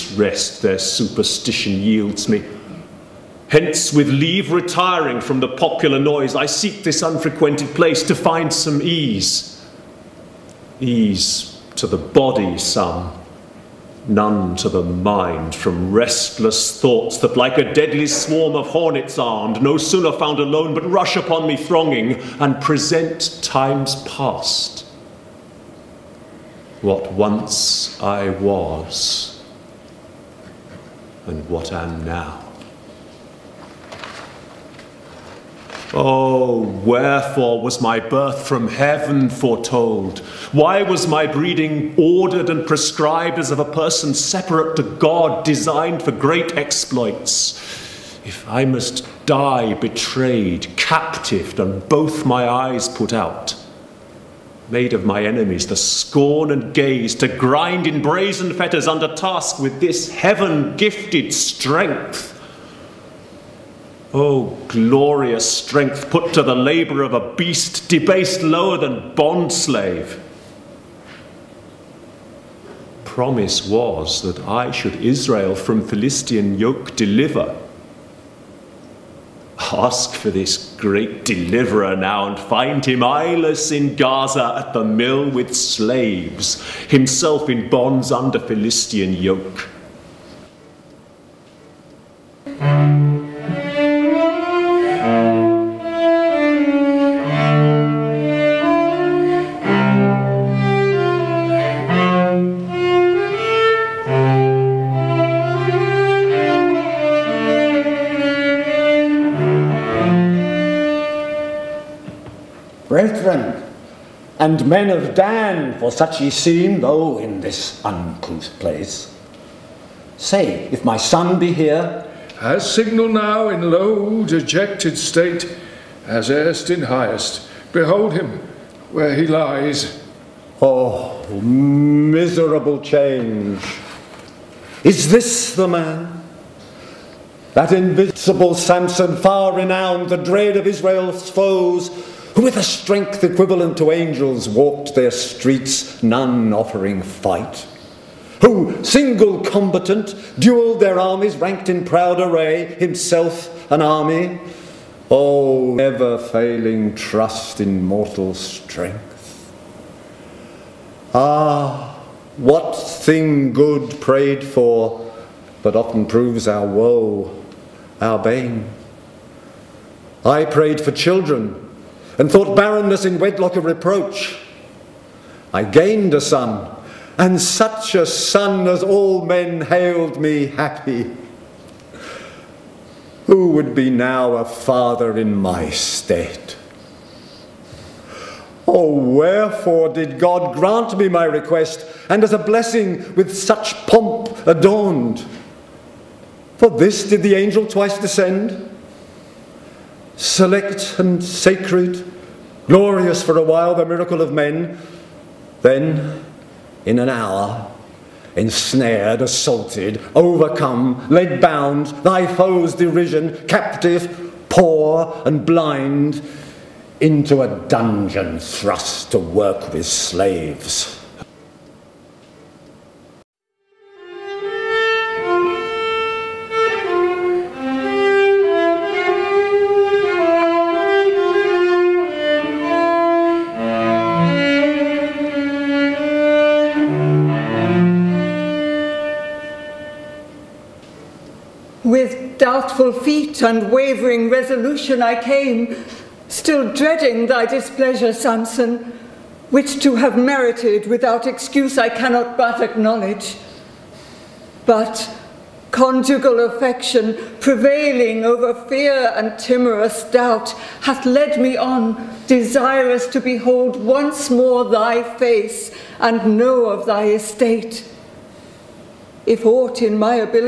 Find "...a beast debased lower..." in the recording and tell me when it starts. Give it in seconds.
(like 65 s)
67 s.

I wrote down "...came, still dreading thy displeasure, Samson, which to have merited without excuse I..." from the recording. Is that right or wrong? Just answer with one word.
right.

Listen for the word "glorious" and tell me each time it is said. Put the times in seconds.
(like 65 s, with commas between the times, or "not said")
64 s, 202 s.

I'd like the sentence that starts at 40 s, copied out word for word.
Why was my breeding ordered and prescribed as of a person separate to God, designed for great exploits?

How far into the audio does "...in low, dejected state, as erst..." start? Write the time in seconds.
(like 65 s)
123 s.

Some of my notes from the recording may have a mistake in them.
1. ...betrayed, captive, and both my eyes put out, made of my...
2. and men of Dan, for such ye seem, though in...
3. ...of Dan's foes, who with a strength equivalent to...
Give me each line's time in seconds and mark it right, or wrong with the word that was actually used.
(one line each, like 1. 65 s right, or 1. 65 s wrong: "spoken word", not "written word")
1. 49 s right
2. 114 s right
3. 140 s wrong: "Israel", not "Dan".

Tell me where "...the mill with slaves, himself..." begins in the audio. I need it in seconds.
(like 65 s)
84 s.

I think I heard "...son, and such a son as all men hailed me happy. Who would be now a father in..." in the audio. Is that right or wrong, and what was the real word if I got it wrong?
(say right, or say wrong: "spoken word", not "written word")
right.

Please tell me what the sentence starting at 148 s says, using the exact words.
Who, single combatant, duelled their armies, ranked in proud array, himself an army.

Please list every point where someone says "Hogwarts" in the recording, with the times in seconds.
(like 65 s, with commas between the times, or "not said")
not said.